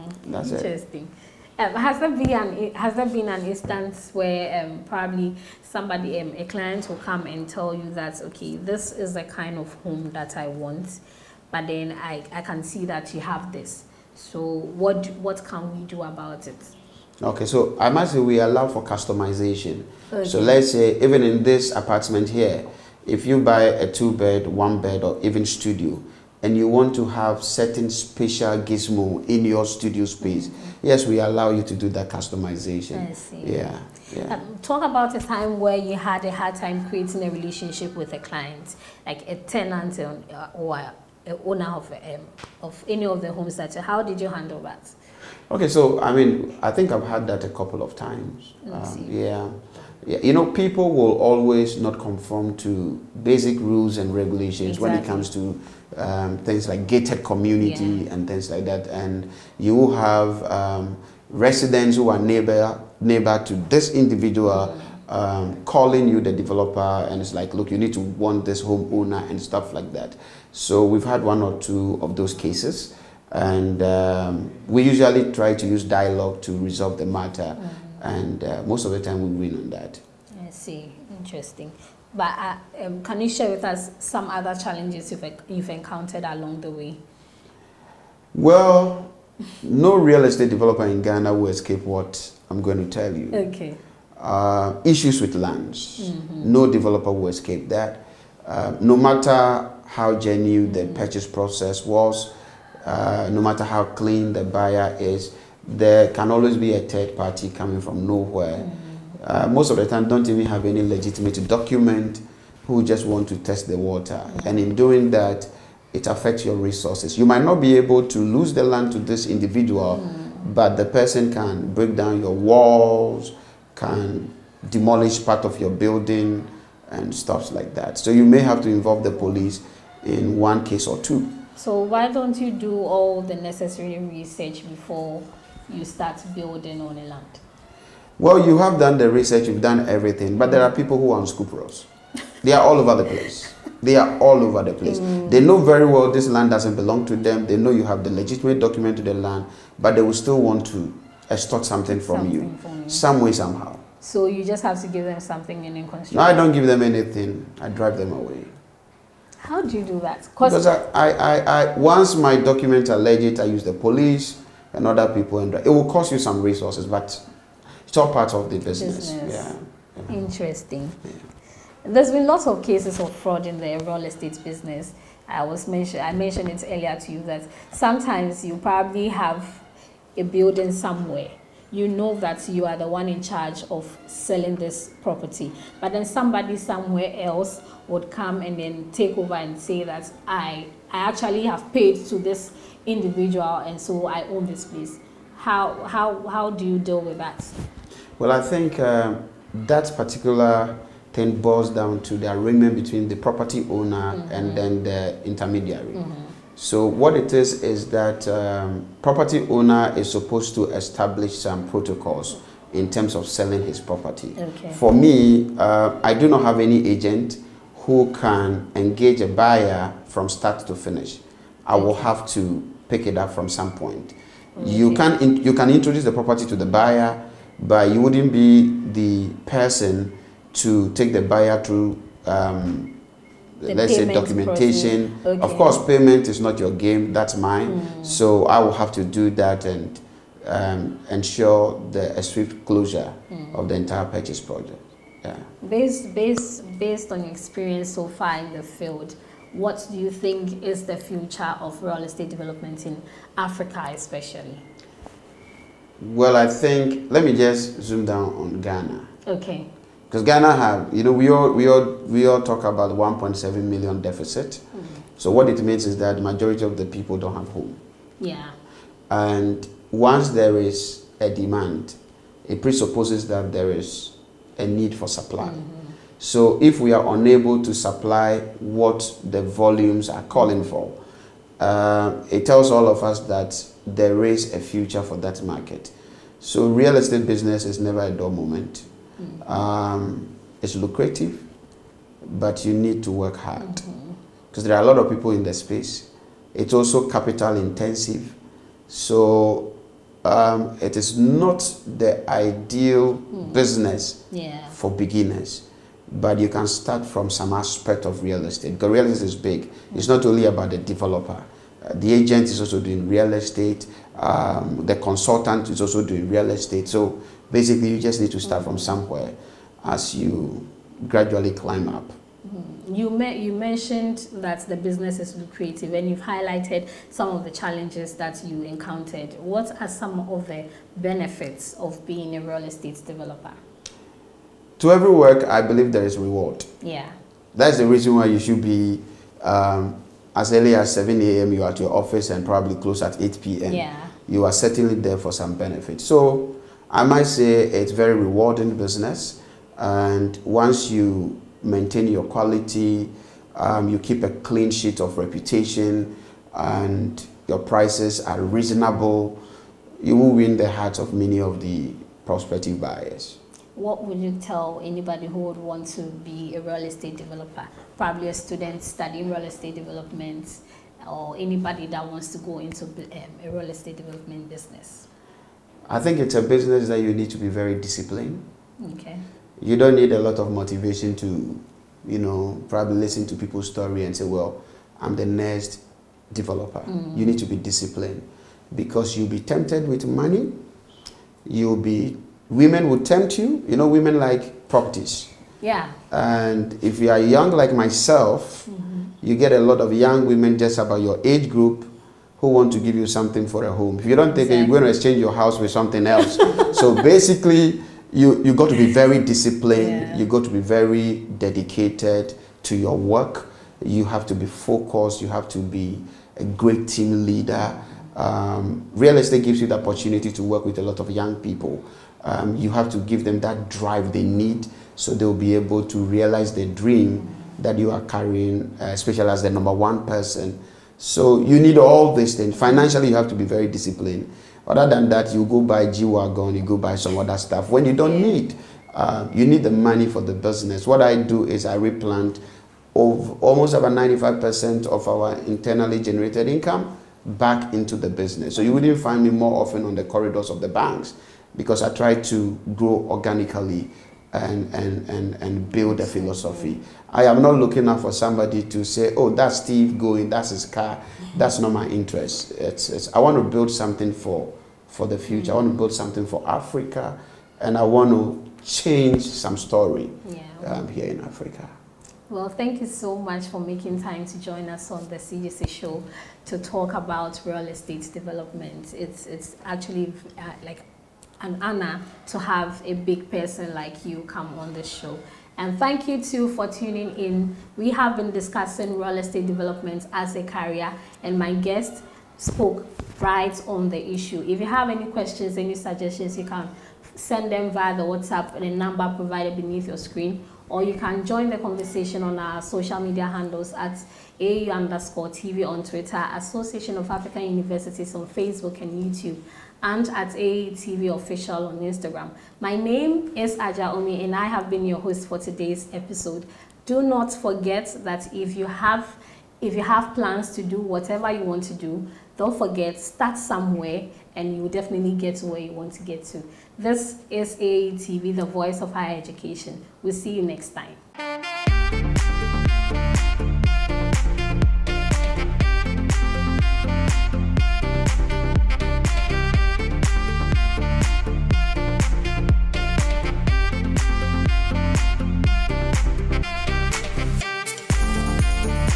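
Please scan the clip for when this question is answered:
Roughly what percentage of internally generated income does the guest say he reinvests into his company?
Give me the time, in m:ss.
7:23.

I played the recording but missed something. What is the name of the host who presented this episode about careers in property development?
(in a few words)
Adjoa Omie.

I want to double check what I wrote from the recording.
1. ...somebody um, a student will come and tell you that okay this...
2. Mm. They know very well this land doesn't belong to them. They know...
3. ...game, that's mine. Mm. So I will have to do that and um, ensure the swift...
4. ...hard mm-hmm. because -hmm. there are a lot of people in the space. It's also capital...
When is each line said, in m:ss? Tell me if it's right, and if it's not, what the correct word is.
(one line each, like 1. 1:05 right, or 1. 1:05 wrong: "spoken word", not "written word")
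1. 0:05 wrong: "client", not "student"
2. 2:24 right
3. 3:56 right
4. 4:53 right.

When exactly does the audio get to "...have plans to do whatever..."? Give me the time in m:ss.
8:39.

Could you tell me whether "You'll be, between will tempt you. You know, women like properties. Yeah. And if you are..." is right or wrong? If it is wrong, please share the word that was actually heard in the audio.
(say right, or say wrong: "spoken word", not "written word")
wrong: "women", not "between".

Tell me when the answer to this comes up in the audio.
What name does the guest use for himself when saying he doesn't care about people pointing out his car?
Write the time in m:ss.
7:39.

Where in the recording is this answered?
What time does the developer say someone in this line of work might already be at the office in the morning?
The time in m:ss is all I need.
5:40.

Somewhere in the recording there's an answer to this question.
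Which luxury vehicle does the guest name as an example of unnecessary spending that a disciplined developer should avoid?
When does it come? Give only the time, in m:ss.
7:15.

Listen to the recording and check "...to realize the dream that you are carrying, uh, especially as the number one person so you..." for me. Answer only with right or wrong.
right.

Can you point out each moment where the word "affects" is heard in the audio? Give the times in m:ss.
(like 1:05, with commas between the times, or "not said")
1:56.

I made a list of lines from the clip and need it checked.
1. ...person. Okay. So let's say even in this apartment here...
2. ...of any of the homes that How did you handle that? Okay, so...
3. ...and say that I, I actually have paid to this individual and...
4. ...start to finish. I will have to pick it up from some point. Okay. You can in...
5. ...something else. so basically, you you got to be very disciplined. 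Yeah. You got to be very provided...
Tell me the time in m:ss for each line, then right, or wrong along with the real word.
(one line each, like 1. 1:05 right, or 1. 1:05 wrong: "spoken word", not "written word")
1. 0:18 wrong: "customization", not "person"
2. 0:42 right
3. 3:09 right
4. 3:40 right
5. 6:45 wrong: "dedicated", not "provided".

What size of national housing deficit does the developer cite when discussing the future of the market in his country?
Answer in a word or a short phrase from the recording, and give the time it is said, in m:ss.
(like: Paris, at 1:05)
1.7 million, at 4:22.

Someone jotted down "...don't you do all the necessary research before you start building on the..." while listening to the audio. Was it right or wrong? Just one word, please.
right.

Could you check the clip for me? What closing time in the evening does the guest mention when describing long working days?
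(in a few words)
8 p.m.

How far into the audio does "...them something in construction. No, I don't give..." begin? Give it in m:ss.
2:35.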